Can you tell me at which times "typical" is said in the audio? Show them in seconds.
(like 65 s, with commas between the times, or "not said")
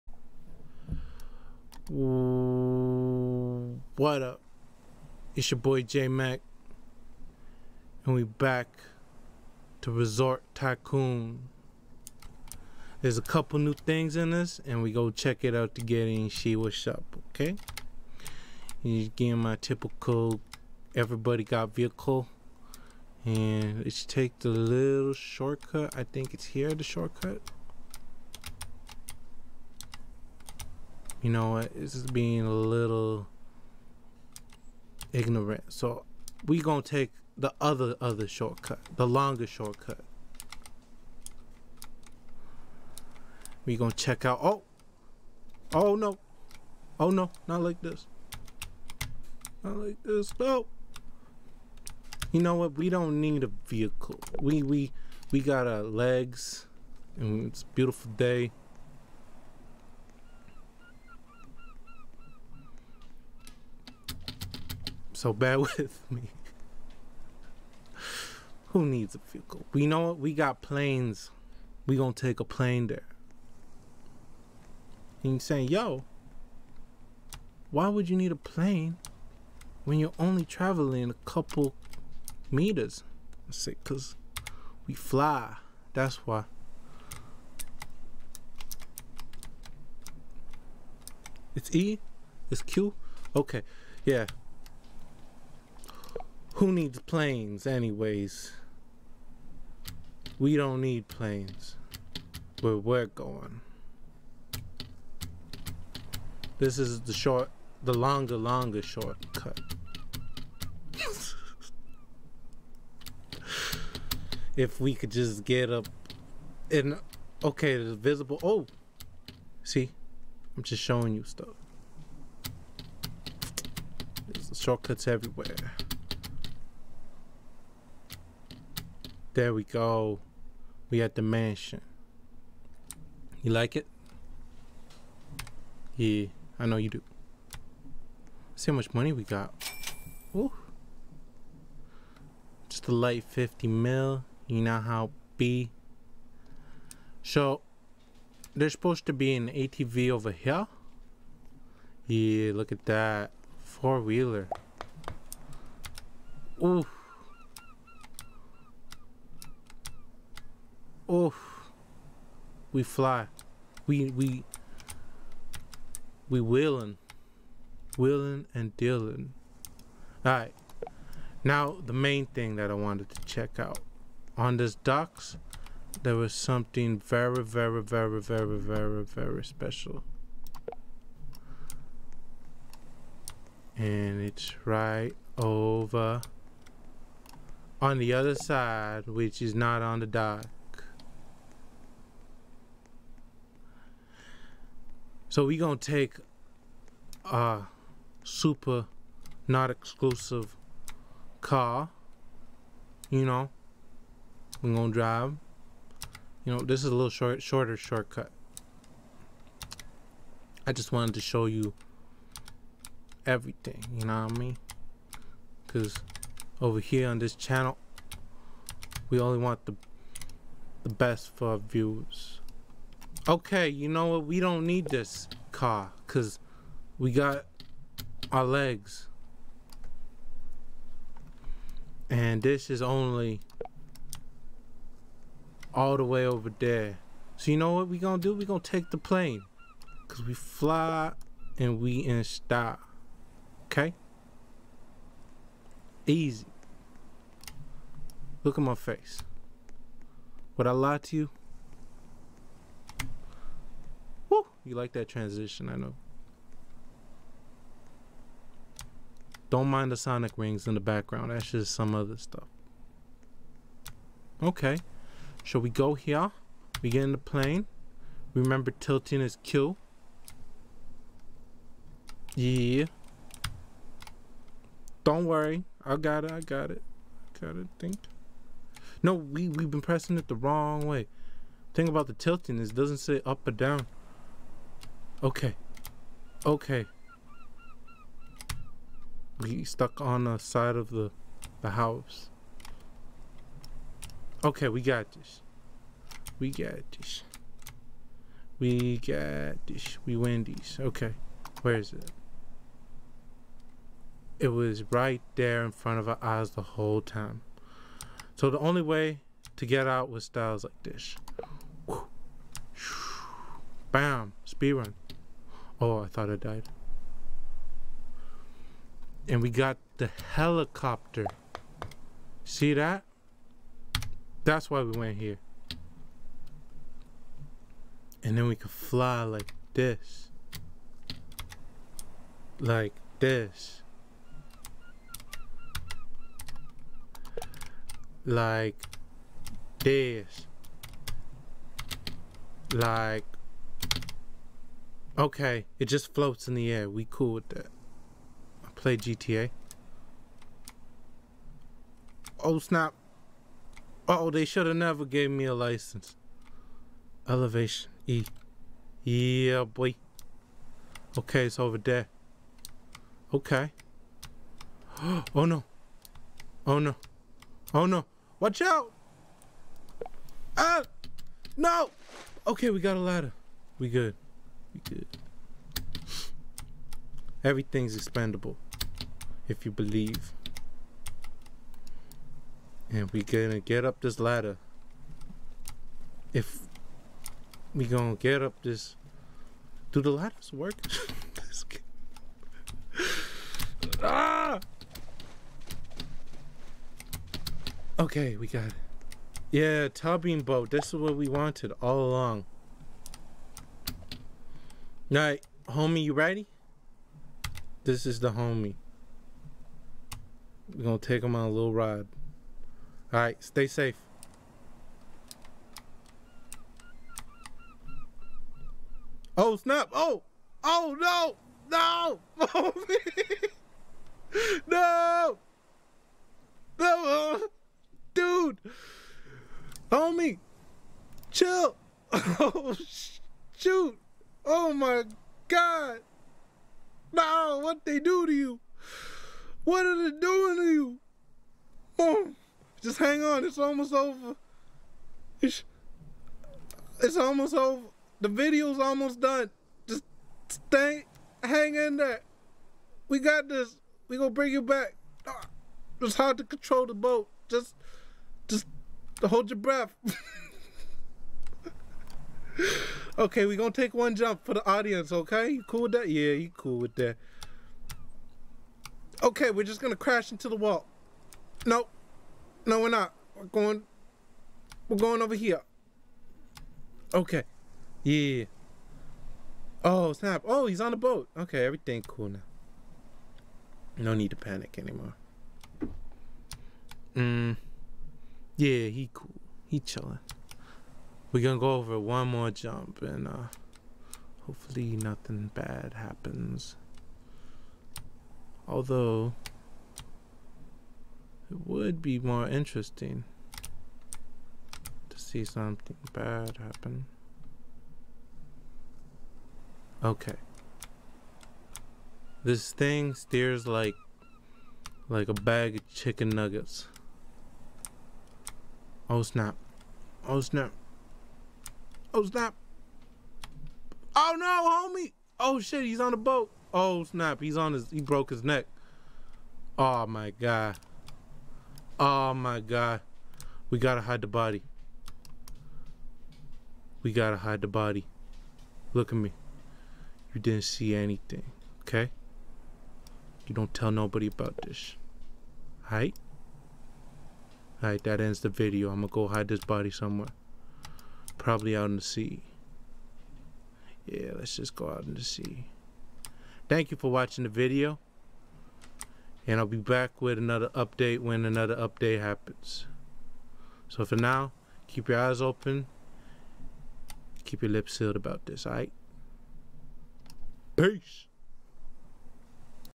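19 s.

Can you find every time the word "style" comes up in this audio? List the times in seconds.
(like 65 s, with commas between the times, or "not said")
242 s, 310 s.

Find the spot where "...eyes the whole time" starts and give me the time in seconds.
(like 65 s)
306 s.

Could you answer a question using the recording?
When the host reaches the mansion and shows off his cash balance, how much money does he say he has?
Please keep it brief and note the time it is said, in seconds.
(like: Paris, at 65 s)
50 mil, at 143 s.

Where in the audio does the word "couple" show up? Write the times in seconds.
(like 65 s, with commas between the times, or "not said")
13 s, 81 s.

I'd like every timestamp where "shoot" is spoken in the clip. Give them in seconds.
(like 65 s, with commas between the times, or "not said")
433 s.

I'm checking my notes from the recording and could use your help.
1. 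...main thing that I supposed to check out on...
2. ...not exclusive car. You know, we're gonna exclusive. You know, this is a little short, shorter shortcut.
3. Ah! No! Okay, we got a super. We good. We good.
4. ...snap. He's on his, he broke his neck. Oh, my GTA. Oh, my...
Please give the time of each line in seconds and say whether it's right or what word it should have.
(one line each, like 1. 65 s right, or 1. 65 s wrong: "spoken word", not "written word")
1. 171 s wrong: "wanted", not "supposed"
2. 199 s wrong: "drive", not "exclusive"
3. 370 s wrong: "ladder", not "super"
4. 527 s wrong: "God", not "GTA".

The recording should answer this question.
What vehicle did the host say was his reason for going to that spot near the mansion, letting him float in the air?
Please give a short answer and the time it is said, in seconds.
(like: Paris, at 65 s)
helicopter, at 320 s.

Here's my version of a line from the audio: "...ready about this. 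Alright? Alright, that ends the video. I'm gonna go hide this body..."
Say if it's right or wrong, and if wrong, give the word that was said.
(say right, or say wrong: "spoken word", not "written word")
wrong: "nobody", not "ready".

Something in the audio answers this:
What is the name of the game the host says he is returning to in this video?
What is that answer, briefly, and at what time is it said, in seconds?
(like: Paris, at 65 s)
Resort Tycoon, at 9 s.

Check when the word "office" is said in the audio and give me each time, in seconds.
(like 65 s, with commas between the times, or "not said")
not said.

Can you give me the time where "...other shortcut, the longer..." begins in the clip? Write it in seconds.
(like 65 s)
38 s.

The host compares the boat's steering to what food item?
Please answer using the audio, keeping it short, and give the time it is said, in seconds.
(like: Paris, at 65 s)
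bag of chicken nuggets, at 515 s.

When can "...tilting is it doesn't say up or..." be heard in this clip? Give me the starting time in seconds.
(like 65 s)
282 s.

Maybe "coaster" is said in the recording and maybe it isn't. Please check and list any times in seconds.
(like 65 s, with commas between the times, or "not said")
not said.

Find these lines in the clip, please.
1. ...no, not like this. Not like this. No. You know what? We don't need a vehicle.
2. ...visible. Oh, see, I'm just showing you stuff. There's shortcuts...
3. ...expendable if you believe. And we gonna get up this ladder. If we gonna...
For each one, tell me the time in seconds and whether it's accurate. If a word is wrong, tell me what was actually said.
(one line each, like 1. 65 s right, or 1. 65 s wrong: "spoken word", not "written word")
1. 47 s right
2. 117 s right
3. 377 s right.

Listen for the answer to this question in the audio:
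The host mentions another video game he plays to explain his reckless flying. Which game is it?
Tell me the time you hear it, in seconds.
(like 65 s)
348 s.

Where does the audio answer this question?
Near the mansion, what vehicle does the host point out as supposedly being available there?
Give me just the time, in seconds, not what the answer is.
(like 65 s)
149 s.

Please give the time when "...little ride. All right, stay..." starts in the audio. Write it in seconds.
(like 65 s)
411 s.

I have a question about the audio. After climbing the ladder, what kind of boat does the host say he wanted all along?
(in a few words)
tubing boat.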